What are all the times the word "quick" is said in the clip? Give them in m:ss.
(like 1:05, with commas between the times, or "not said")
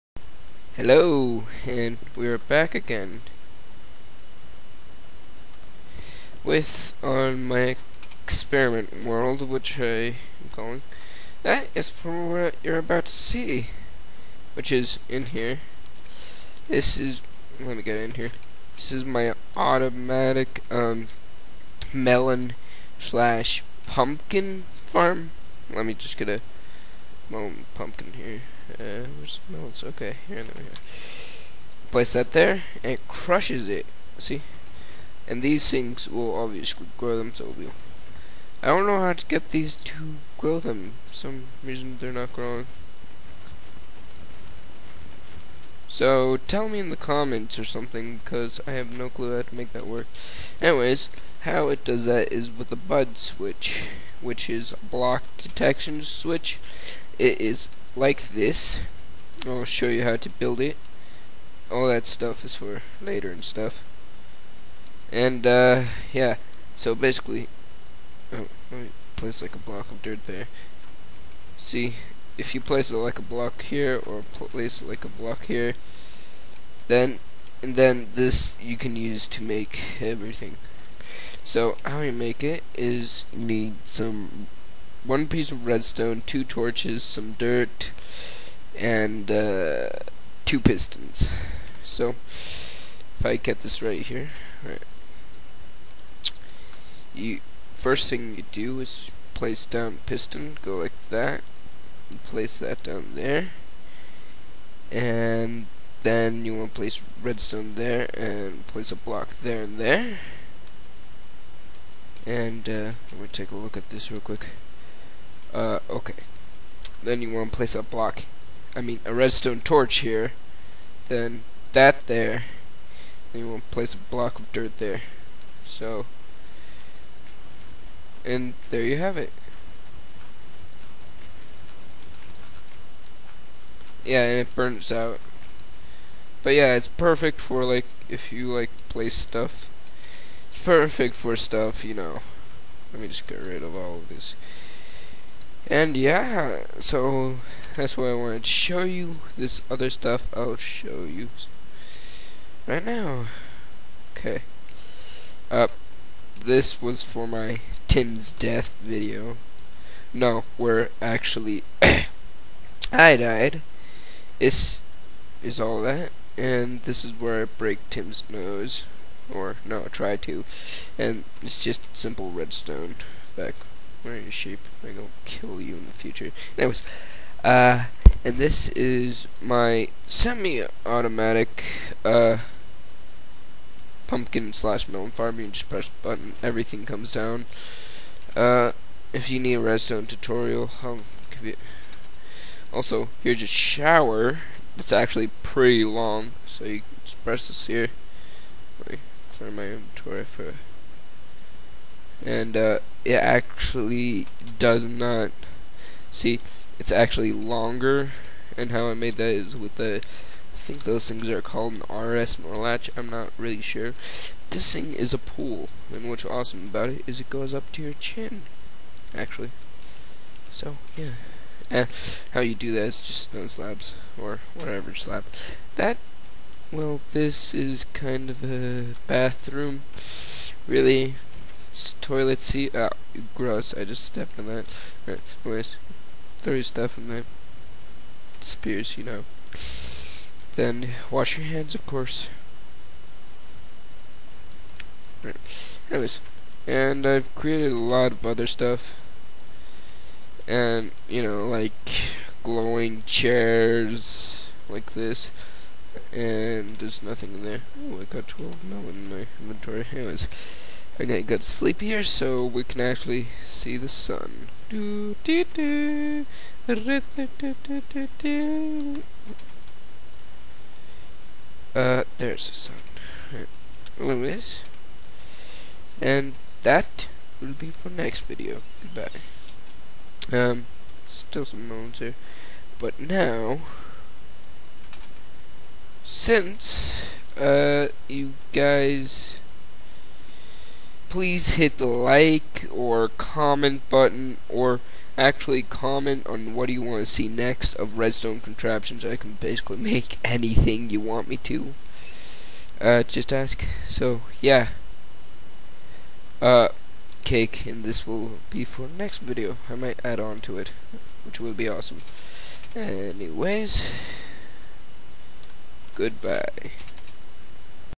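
1:54.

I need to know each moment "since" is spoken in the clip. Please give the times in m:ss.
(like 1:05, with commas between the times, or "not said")
4:46.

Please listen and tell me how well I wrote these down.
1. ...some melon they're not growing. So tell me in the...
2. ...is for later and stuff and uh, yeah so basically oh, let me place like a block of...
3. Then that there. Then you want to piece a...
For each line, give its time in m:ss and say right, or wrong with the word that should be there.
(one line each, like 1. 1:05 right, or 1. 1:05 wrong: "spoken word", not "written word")
1. 0:41 wrong: "reason", not "melon"
2. 1:02 right
3. 2:01 wrong: "place", not "piece".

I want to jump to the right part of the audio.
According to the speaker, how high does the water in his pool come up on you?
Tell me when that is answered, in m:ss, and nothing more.
3:37.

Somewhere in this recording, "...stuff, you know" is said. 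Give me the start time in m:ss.
2:21.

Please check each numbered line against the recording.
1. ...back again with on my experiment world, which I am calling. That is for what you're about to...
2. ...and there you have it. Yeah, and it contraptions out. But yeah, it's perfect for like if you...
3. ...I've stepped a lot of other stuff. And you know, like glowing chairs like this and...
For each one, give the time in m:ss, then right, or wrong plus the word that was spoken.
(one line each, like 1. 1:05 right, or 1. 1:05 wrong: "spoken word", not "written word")
1. 0:02 right
2. 2:08 wrong: "burns", not "contraptions"
3. 4:07 wrong: "created", not "stepped".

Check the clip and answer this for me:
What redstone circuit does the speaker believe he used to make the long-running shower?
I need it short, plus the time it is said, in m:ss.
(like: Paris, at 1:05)
RS NOR latch, at 3:31.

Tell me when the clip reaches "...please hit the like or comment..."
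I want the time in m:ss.
4:51.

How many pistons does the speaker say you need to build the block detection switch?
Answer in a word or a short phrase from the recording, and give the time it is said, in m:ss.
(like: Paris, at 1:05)
2, at 1:30.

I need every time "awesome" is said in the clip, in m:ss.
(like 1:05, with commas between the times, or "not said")
3:36, 5:11.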